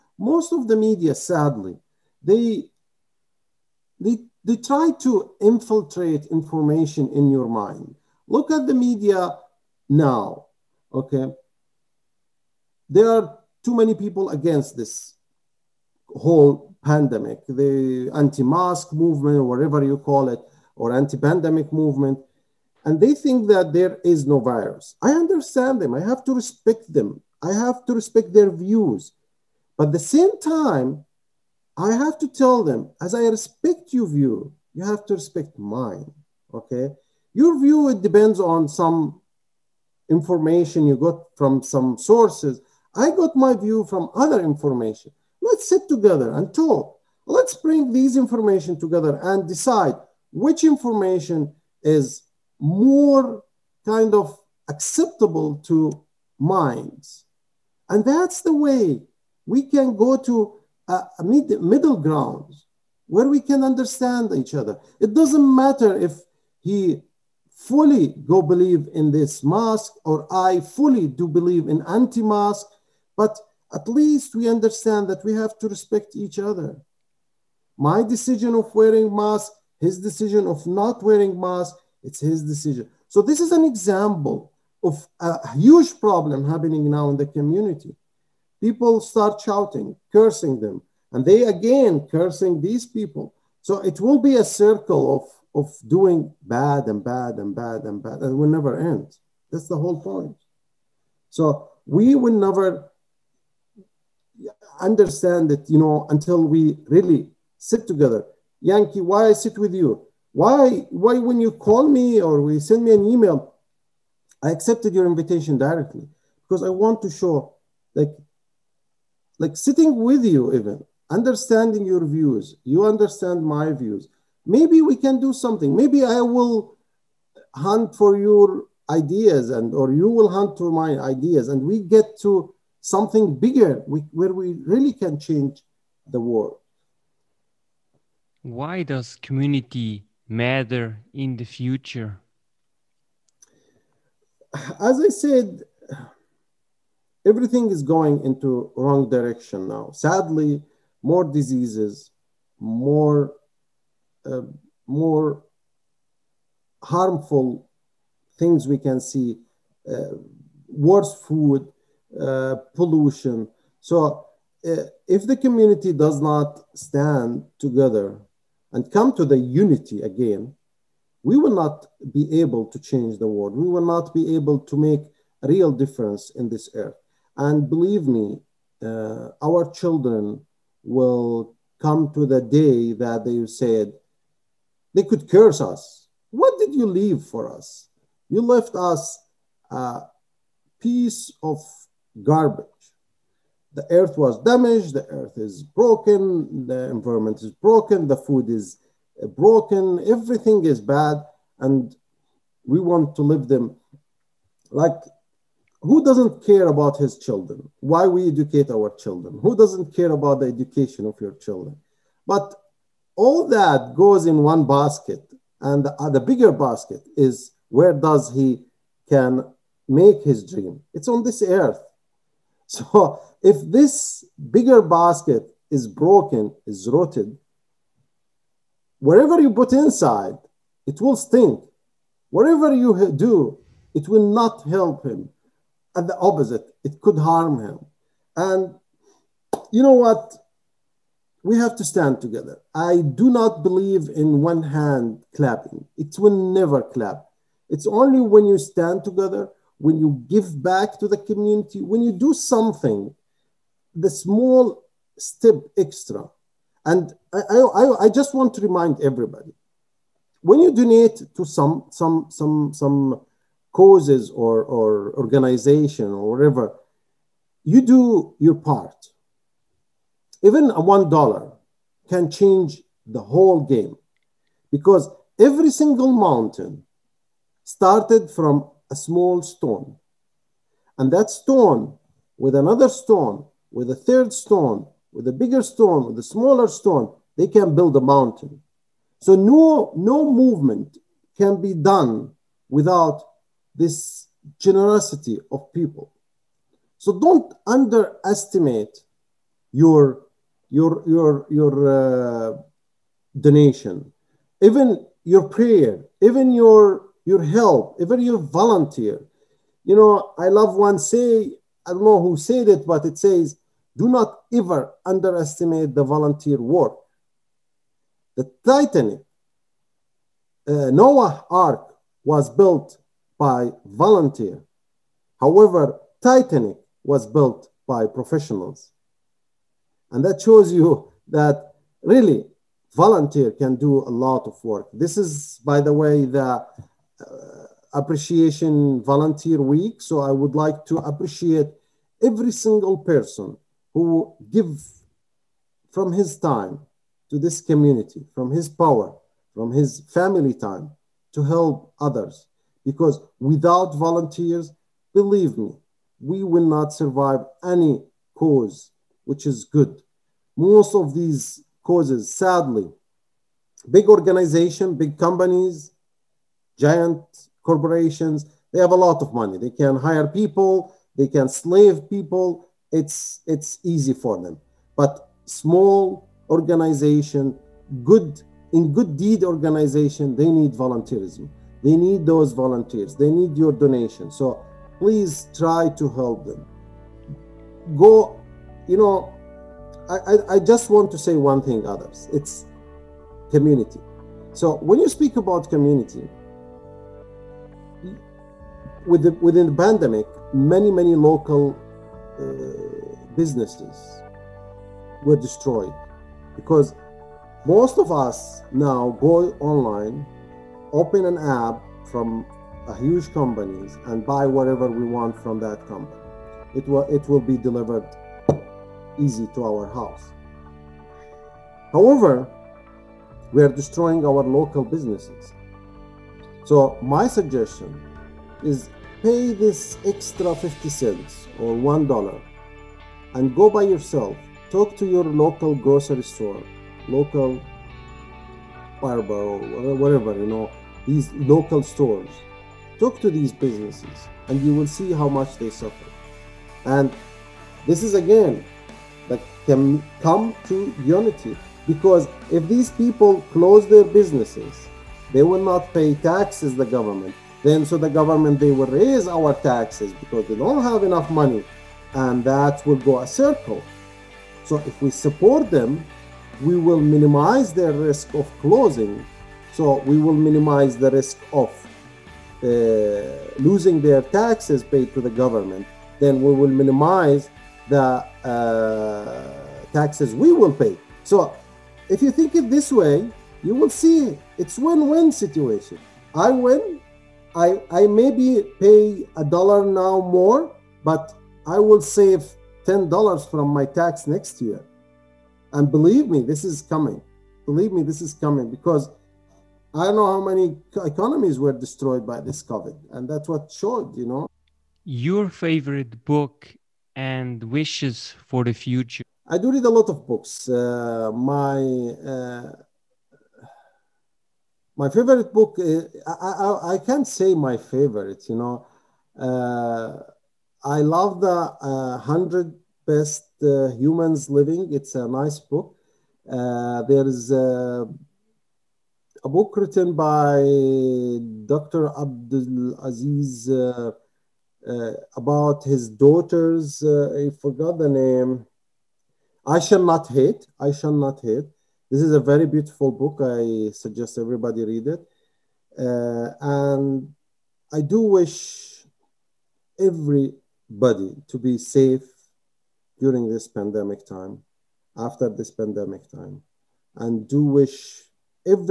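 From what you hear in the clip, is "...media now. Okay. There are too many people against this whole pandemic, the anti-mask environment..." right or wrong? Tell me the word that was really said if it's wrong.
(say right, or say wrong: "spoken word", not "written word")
wrong: "movement", not "environment".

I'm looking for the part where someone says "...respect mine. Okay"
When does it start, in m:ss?
0:35.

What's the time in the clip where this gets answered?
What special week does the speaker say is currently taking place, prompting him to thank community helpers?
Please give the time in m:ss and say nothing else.
5:37.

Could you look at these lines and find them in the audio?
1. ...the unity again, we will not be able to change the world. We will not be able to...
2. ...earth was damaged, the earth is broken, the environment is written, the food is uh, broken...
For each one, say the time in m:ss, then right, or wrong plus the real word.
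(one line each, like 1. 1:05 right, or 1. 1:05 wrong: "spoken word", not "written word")
1. 2:49 right
2. 3:13 wrong: "broken", not "written".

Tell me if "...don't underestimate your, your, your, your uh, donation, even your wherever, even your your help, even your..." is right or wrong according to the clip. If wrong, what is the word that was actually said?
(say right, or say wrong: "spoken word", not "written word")
wrong: "prayer", not "wherever".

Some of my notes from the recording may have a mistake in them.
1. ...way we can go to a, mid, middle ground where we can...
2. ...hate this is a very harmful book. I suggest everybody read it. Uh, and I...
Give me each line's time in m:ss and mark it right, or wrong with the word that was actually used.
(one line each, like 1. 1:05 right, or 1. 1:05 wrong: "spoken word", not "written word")
1. 0:58 right
2. 9:01 wrong: "beautiful", not "harmful".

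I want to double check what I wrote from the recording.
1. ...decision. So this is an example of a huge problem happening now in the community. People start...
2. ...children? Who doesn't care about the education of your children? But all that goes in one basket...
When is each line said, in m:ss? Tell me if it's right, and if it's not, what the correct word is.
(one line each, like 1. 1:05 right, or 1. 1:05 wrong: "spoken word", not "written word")
1. 1:22 right
2. 3:28 right.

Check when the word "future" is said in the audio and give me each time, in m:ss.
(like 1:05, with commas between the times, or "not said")
2:21, 8:28.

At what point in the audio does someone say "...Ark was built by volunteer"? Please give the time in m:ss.
5:21.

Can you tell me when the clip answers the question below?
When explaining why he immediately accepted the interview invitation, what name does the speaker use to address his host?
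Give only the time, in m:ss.
1:48.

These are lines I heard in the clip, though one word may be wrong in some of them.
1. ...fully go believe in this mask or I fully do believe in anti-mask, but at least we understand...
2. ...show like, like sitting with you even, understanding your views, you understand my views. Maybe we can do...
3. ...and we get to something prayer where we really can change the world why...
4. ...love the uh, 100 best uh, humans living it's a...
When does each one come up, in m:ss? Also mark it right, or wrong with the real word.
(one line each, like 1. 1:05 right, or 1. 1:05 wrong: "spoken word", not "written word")
1. 1:07 right
2. 1:57 right
3. 2:11 wrong: "bigger", not "prayer"
4. 8:41 right.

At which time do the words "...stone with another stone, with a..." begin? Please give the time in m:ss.
4:41.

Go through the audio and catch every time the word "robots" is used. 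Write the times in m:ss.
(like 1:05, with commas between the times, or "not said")
not said.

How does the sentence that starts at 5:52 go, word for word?
Because without volunteers, believe me, we will not survive any cause which is good.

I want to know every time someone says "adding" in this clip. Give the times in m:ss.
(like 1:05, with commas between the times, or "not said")
not said.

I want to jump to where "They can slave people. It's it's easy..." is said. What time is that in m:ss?
6:11.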